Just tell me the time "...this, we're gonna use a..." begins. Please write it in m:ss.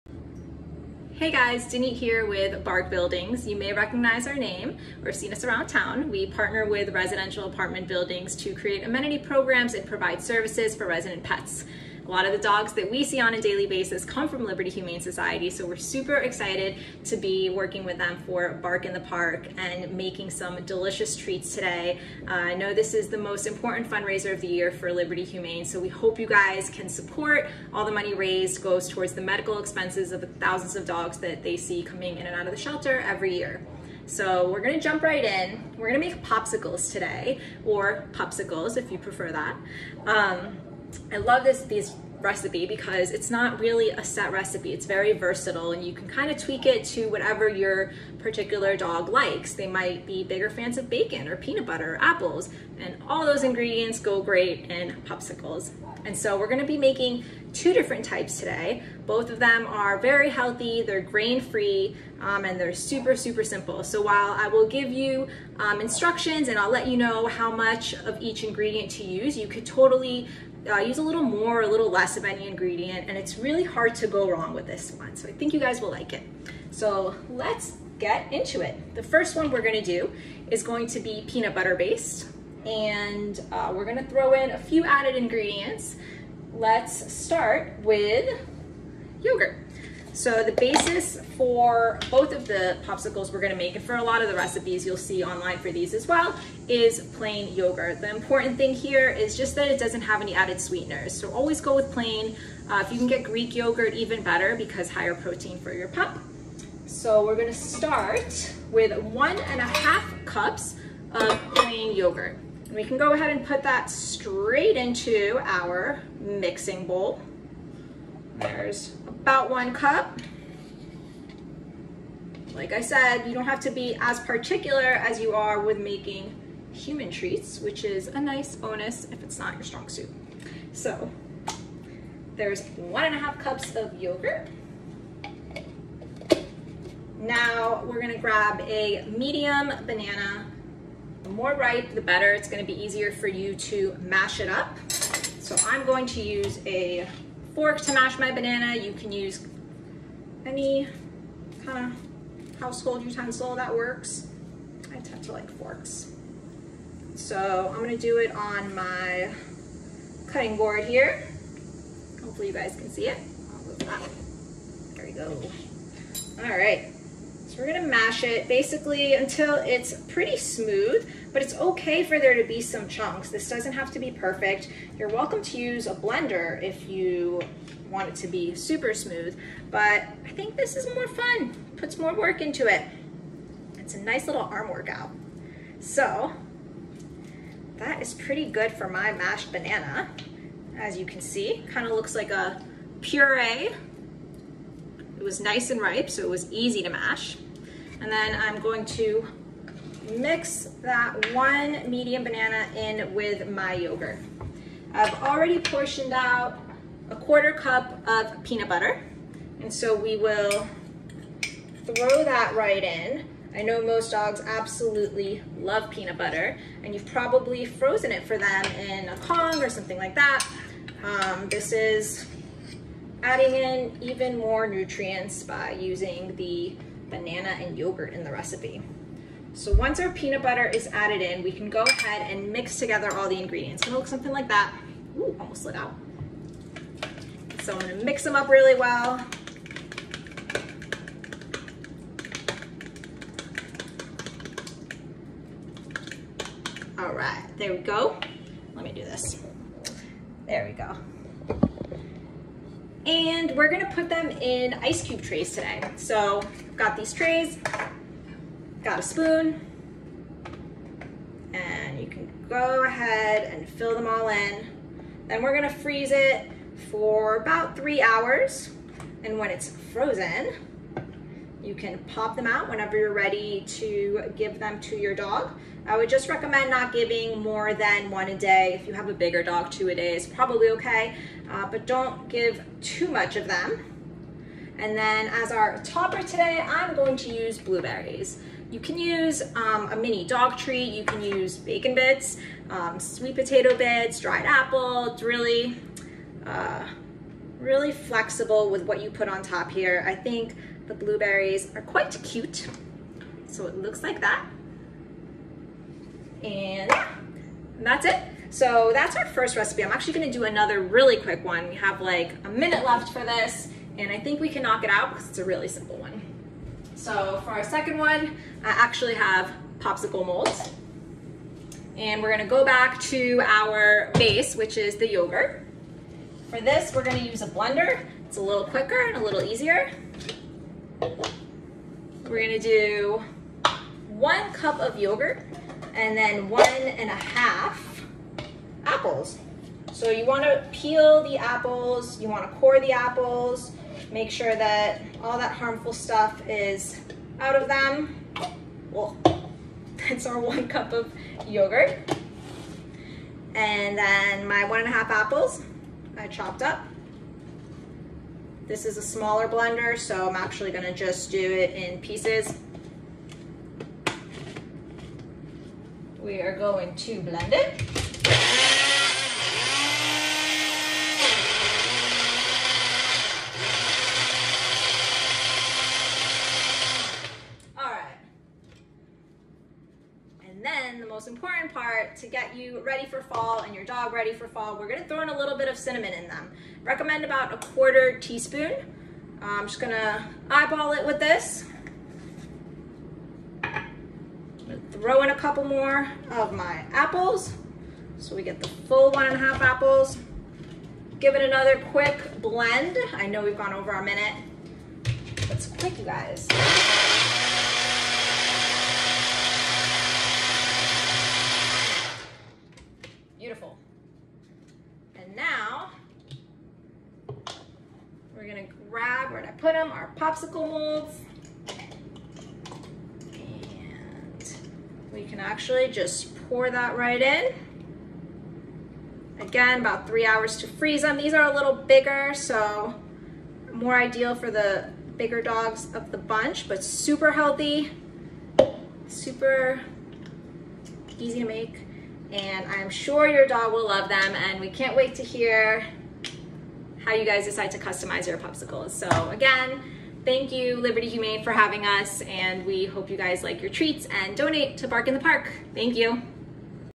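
5:26.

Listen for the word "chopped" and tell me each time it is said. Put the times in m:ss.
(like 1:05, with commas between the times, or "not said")
5:56.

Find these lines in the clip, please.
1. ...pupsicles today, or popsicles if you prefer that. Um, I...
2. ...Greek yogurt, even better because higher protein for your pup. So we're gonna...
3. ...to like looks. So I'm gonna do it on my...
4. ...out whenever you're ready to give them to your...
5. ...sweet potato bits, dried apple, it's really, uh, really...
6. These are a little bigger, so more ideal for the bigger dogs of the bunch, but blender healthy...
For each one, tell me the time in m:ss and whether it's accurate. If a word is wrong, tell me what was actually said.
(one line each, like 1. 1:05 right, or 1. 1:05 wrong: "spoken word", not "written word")
1. 0:36 right
2. 1:43 right
3. 2:35 wrong: "forks", not "looks"
4. 4:32 right
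5. 4:52 right
6. 7:11 wrong: "super", not "blender".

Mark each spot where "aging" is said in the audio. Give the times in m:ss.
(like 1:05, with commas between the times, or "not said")
not said.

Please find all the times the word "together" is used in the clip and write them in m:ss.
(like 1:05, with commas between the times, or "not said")
3:52.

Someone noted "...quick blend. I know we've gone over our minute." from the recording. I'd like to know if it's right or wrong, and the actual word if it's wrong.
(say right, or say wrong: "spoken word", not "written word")
right.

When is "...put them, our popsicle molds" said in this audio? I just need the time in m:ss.
6:59.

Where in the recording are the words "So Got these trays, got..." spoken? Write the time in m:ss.
4:15.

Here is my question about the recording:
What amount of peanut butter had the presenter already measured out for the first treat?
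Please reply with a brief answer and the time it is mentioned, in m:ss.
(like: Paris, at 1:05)
a quarter cup, at 3:27.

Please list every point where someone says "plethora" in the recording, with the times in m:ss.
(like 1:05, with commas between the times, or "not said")
not said.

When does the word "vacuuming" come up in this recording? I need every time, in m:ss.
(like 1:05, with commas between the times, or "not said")
not said.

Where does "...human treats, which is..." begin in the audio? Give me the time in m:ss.
2:06.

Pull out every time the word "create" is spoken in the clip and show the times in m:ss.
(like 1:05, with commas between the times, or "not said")
0:08.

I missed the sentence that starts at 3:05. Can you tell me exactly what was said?
So that is pretty good for my mashed banana.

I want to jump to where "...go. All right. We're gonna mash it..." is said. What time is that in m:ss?
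2:45.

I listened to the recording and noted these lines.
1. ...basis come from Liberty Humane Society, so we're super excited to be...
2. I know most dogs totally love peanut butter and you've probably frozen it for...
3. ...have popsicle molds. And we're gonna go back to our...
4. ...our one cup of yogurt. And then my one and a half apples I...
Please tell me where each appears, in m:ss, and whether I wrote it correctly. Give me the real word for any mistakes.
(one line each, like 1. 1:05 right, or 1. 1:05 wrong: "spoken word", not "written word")
1. 0:13 right
2. 3:33 wrong: "absolutely", not "totally"
3. 5:19 right
4. 5:50 right.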